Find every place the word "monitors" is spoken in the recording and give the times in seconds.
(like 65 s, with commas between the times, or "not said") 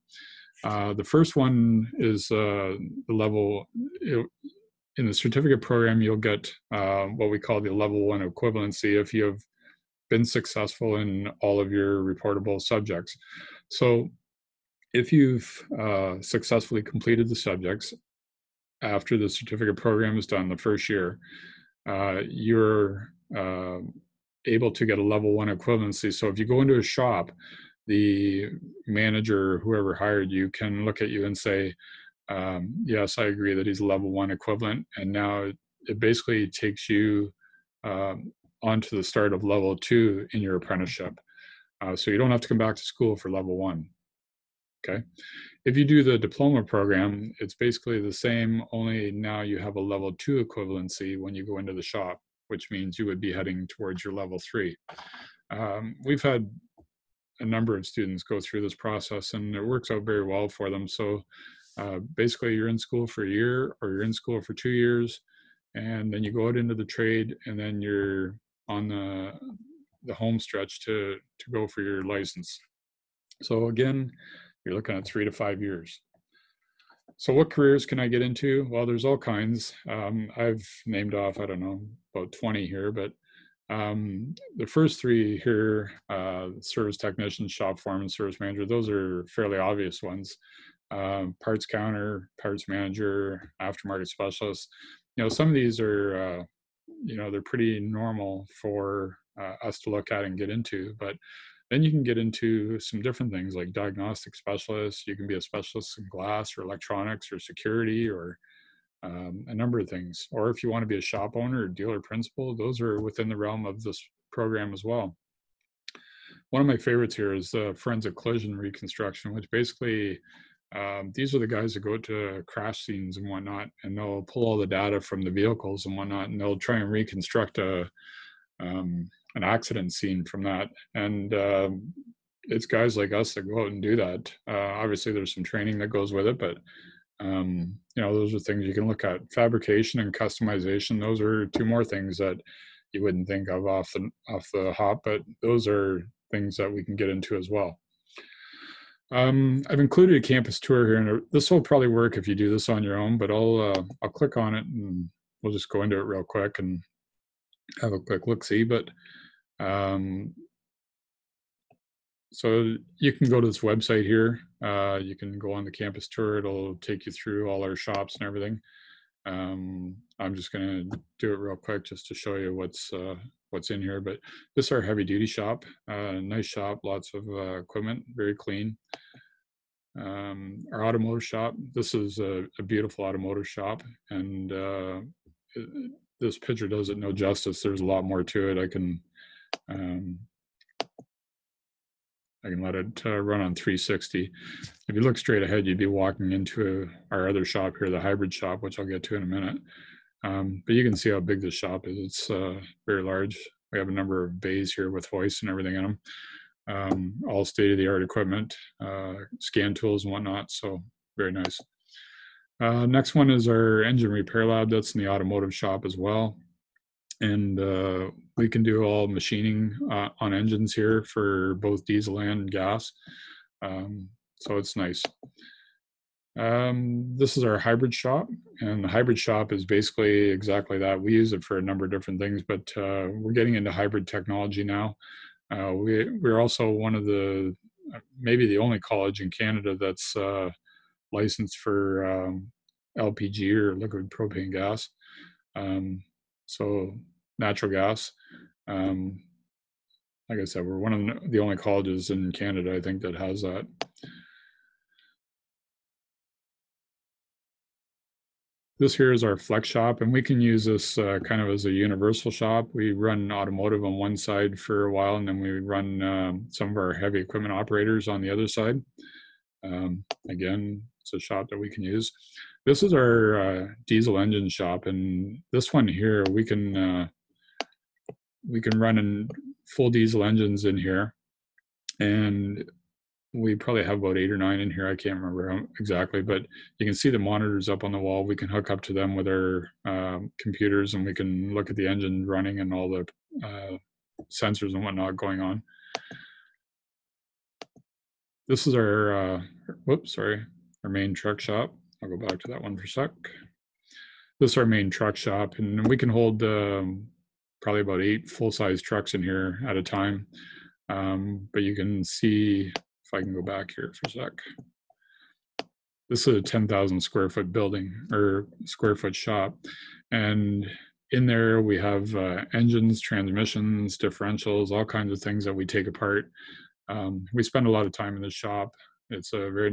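287 s.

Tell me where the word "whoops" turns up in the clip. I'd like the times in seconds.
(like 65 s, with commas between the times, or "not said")
299 s.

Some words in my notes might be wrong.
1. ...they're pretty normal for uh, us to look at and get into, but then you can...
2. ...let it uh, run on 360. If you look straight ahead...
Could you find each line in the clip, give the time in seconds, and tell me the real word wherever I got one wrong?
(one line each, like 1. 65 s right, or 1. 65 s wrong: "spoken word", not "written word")
1. 97 s right
2. 192 s right.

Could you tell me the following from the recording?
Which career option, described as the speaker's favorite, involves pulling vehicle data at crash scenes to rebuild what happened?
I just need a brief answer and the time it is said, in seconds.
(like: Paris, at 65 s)
Forensic collision reconstruction, at 117 s.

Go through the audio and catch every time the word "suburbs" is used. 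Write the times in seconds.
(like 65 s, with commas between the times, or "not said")
not said.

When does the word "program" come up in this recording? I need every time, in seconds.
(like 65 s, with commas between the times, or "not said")
5 s, 19 s, 46 s, 114 s.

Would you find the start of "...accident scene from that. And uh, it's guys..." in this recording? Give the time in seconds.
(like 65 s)
129 s.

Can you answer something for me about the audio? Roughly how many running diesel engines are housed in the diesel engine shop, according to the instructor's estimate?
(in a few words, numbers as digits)
8 or 9.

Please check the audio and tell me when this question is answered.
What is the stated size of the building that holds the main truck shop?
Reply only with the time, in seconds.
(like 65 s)
316 s.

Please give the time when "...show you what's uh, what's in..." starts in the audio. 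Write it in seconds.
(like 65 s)
172 s.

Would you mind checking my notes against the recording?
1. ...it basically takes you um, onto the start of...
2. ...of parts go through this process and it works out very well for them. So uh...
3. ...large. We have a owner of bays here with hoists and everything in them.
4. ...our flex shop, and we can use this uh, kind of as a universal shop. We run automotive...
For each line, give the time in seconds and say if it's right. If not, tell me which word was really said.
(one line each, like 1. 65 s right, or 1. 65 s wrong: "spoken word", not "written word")
1. 35 s right
2. 57 s wrong: "students", not "parts"
3. 203 s wrong: "number", not "owner"
4. 259 s right.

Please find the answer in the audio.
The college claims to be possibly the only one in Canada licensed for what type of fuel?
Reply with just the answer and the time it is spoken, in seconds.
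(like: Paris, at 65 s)
Liquid propane gas, at 243 s.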